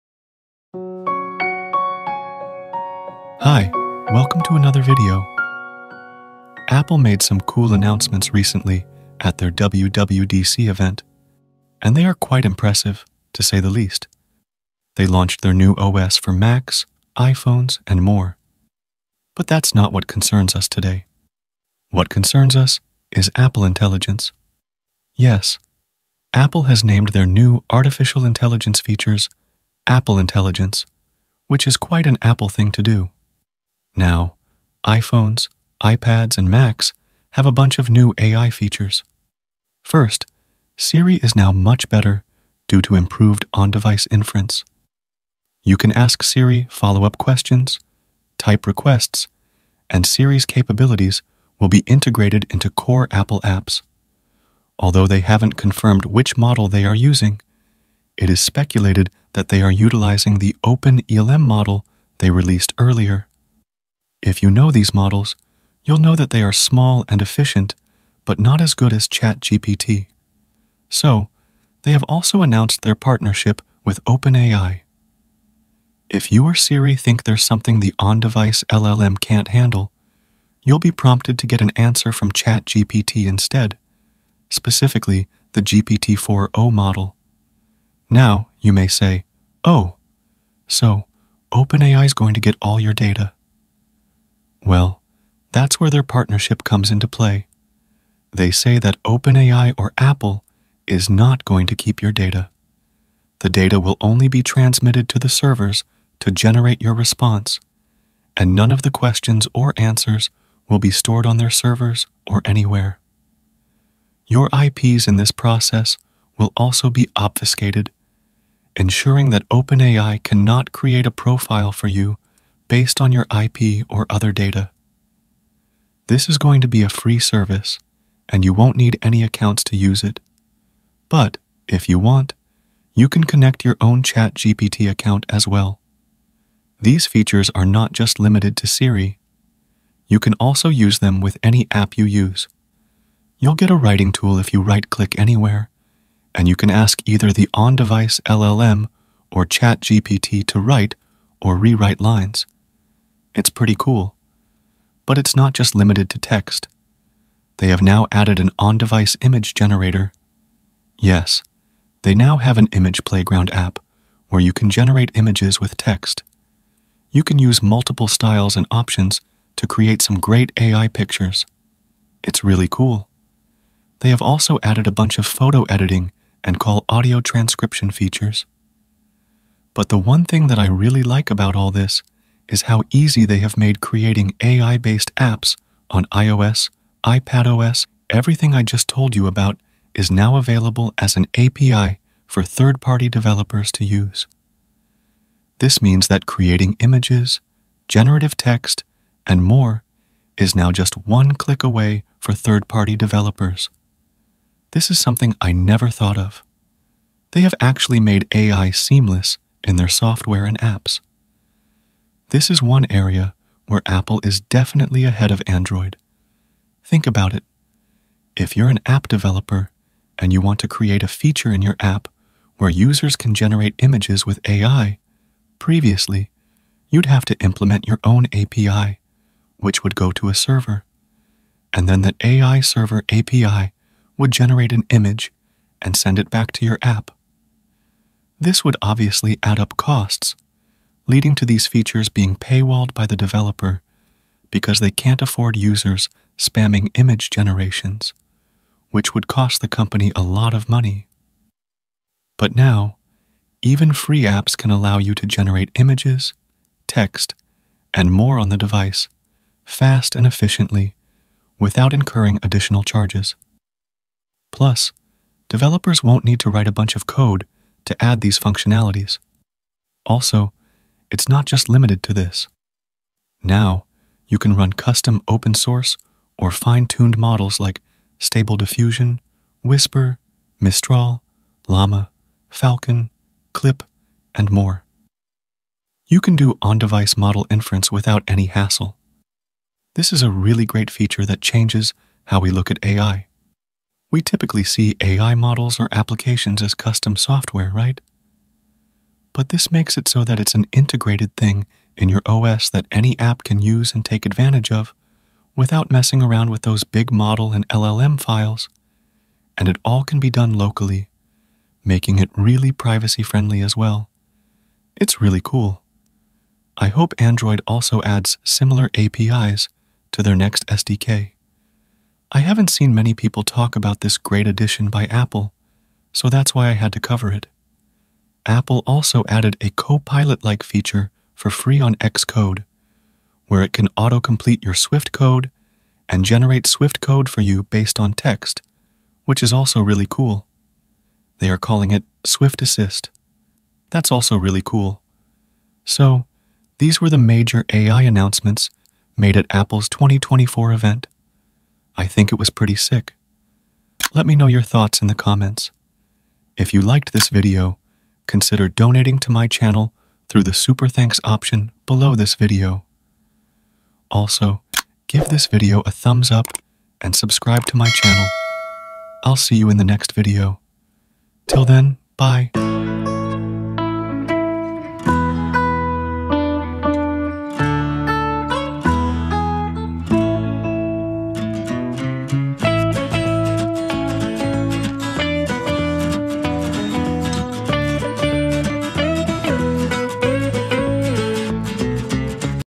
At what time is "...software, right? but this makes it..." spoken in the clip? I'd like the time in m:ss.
4:57.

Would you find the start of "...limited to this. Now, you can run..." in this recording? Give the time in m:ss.
4:31.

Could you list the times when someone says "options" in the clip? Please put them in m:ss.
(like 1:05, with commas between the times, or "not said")
2:48, 6:01.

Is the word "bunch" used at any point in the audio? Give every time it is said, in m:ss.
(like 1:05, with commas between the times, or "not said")
0:37, 2:54, 4:26.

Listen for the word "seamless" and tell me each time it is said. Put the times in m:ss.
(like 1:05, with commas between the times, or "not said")
3:28.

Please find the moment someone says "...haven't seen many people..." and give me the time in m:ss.
5:22.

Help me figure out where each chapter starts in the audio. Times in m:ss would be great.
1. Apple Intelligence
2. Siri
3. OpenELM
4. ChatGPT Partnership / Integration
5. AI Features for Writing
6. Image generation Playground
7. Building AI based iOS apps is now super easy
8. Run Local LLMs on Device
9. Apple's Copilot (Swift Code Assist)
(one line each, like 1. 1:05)
1. 0:19
2. 0:40
3. 0:55
4. 1:10
5. 2:16
6. 2:34
7. 3:07
8. 4:34
9. 5:28.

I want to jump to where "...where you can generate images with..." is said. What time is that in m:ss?
2:44.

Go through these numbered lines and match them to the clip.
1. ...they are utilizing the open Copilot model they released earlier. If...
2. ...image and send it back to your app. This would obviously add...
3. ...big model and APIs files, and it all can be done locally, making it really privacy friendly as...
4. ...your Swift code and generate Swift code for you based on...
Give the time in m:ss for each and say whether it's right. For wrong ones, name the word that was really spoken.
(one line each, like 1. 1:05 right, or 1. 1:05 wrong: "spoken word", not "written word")
1. 0:59 wrong: "ELM", not "Copilot"
2. 3:54 right
3. 5:06 wrong: "LLM", not "APIs"
4. 5:34 right.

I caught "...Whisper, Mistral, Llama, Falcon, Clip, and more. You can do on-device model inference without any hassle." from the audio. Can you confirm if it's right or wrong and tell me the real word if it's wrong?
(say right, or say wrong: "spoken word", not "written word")
right.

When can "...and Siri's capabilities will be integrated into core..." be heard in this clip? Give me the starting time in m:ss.
0:49.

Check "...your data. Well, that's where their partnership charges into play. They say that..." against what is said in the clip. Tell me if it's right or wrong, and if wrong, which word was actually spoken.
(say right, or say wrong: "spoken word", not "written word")
wrong: "comes", not "charges".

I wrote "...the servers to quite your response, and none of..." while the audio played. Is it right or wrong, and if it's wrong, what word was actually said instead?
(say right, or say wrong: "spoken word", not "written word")
wrong: "generate", not "quite".